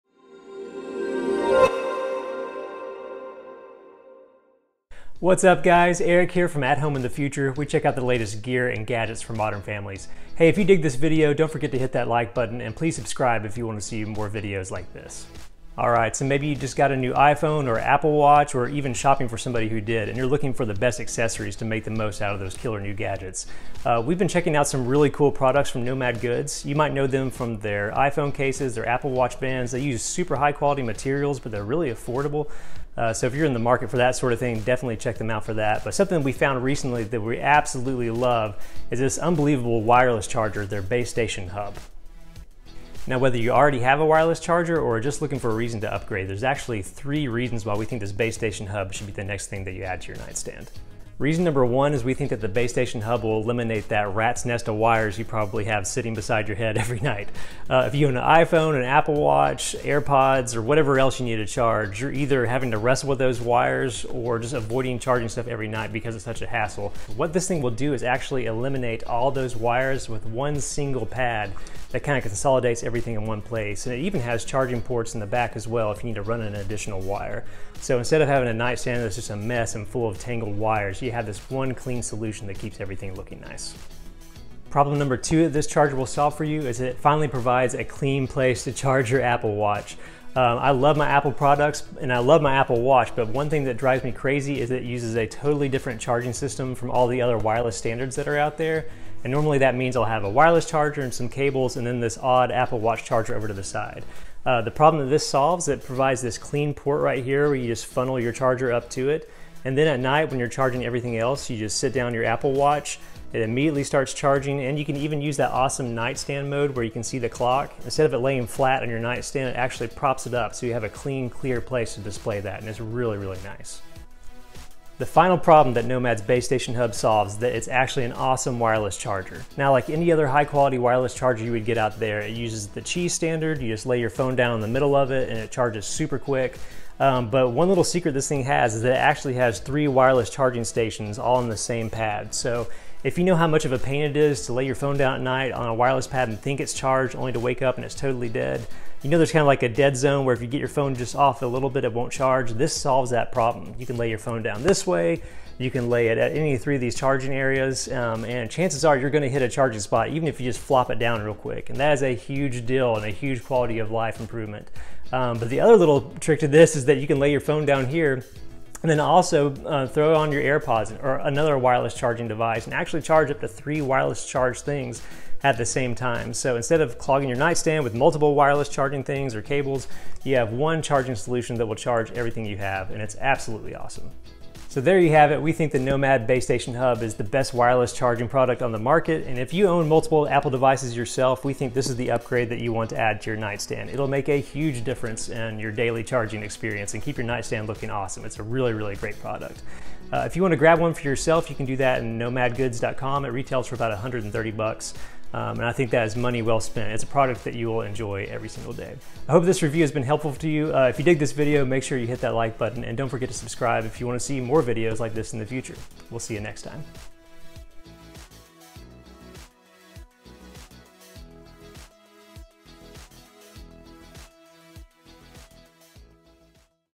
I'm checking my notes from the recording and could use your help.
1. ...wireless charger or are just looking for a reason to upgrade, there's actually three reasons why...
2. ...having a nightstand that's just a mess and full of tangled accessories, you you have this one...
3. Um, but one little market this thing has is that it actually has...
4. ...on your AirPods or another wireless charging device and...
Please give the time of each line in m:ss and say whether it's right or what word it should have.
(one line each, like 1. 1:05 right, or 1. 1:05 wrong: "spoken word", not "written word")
1. 0:44 right
2. 1:18 wrong: "wires", not "accessories"
3. 2:16 wrong: "secret", not "market"
4. 2:50 right.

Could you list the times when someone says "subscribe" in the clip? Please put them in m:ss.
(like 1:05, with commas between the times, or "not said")
0:12, 3:33.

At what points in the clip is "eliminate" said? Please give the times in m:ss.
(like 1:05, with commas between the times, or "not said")
0:53, 1:08.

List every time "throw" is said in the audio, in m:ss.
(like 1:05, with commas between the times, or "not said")
2:49.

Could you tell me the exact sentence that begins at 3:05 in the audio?
We think the Nomad Base Station Hub is the best wireless charging product on the market.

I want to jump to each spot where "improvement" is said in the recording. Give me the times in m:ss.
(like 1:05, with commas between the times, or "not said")
2:44.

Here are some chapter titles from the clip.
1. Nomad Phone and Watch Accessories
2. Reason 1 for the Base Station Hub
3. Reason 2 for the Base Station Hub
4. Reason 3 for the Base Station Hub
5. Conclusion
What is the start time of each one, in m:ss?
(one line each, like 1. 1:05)
1. 0:16
2. 0:50
3. 1:24
4. 2:04
5. 3:05.